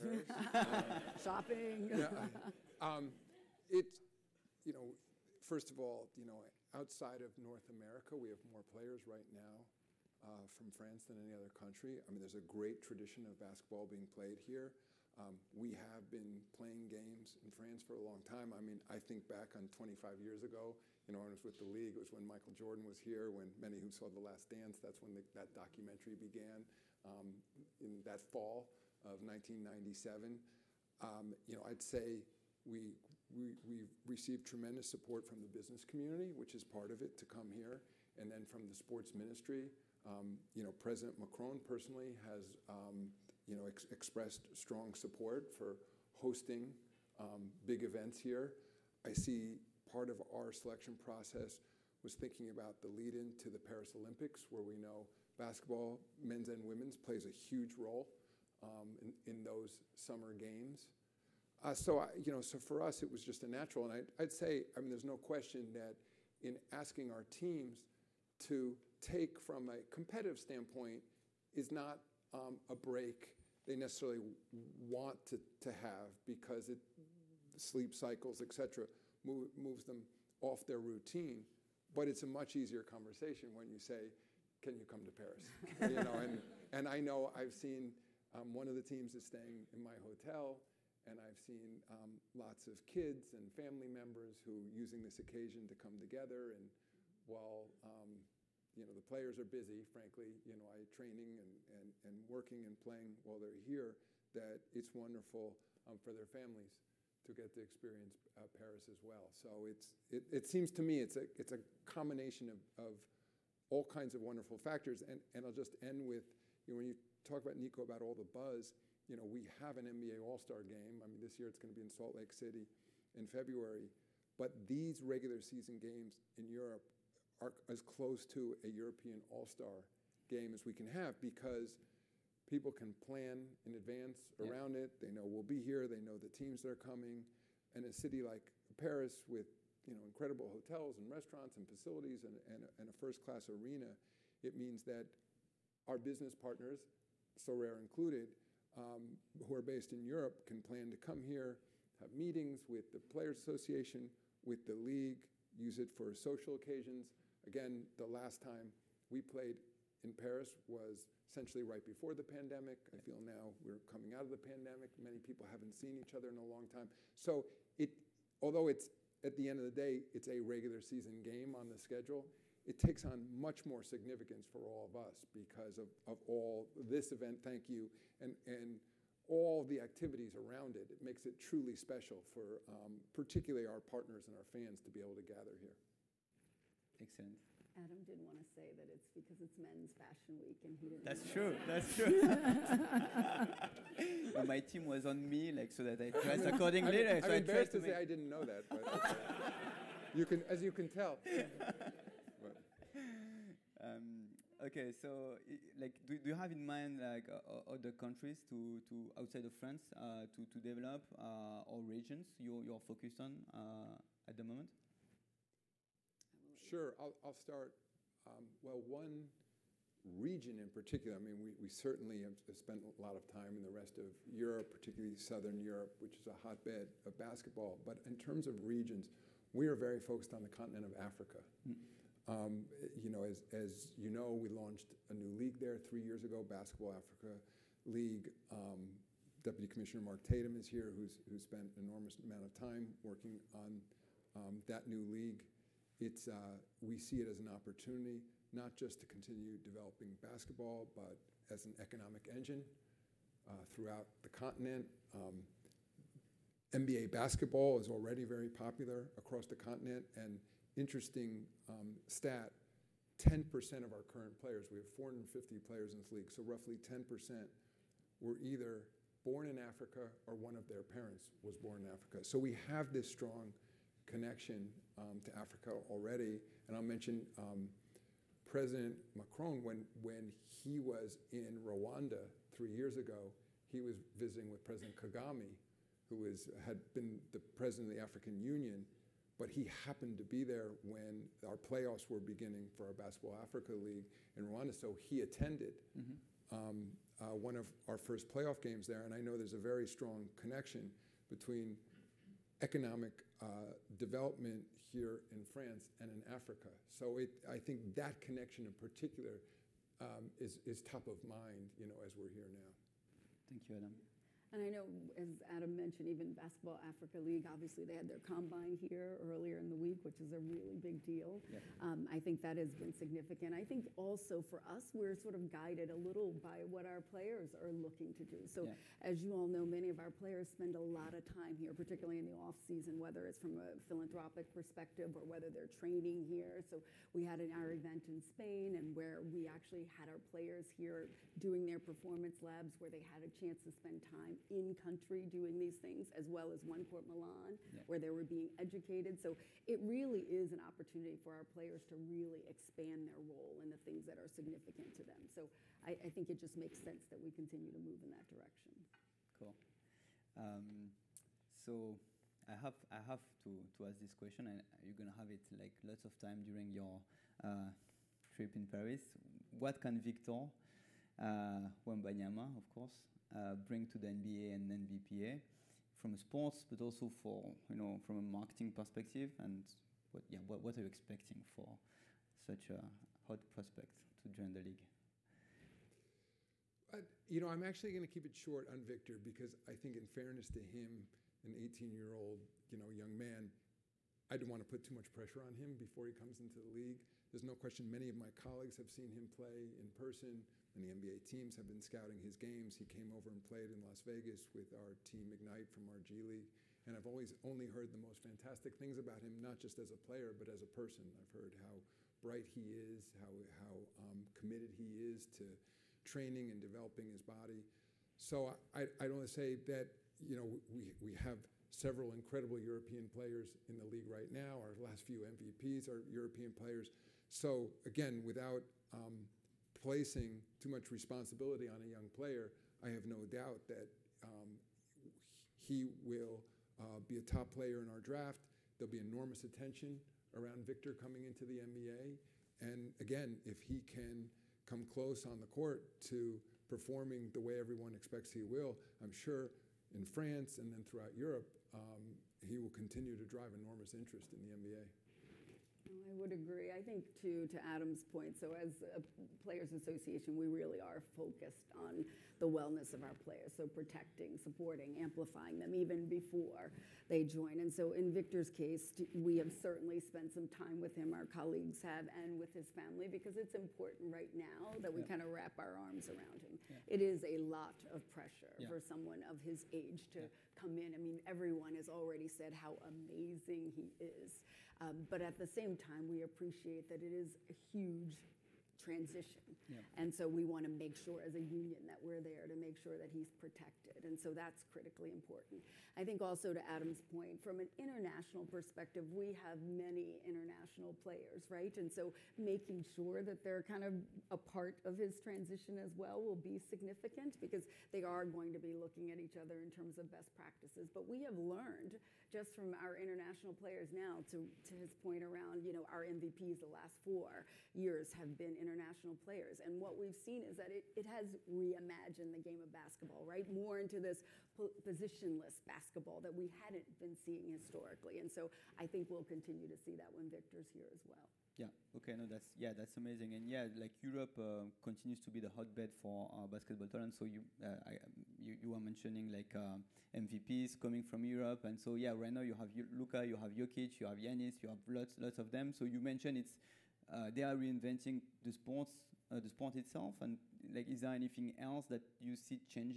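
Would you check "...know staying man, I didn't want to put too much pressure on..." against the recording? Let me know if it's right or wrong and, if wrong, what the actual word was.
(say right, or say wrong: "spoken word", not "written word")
wrong: "young", not "staying".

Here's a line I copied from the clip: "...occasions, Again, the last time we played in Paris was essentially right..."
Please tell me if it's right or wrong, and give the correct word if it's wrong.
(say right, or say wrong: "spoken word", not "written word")
right.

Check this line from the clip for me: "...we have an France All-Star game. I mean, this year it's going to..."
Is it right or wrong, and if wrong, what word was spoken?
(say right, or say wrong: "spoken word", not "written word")
wrong: "NBA", not "France".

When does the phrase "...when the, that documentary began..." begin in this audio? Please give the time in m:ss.
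0:25.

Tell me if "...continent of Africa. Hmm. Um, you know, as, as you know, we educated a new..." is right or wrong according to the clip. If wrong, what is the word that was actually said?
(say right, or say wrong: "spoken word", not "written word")
wrong: "launched", not "educated".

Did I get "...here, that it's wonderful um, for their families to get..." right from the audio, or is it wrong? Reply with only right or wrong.
right.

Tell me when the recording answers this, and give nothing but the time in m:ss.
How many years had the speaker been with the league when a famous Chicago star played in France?
0:19.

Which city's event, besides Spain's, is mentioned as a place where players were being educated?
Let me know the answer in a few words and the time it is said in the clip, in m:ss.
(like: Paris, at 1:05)
Milan, at 5:46.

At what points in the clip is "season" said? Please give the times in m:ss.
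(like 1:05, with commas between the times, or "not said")
2:05, 2:50, 5:32.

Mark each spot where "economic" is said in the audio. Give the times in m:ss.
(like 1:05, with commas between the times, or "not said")
4:11, 5:02.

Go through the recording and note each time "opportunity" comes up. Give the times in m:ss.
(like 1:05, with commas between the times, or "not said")
4:07, 5:50.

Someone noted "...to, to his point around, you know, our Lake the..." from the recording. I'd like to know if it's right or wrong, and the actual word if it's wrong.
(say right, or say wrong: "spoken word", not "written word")
wrong: "MVPs", not "Lake".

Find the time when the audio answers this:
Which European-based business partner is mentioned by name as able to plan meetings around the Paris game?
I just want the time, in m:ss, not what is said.
2:27.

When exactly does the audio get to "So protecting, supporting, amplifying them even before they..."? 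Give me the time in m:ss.
7:43.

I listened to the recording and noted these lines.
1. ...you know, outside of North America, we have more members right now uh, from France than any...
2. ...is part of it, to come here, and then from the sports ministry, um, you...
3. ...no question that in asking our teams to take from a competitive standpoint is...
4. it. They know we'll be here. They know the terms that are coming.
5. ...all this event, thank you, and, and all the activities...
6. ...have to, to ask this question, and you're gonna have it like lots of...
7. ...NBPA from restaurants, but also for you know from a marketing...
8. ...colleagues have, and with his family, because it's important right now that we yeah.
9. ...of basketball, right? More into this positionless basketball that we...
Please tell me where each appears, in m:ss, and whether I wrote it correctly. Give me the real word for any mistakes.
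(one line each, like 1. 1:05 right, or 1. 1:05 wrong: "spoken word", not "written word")
1. 0:06 wrong: "players", not "members"
2. 0:36 right
3. 1:05 right
4. 2:14 wrong: "teams", not "terms"
5. 2:56 right
6. 6:02 right
7. 6:14 wrong: "sports", not "restaurants"
8. 7:51 right
9. 8:42 right.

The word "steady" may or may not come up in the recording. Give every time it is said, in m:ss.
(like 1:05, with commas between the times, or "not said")
not said.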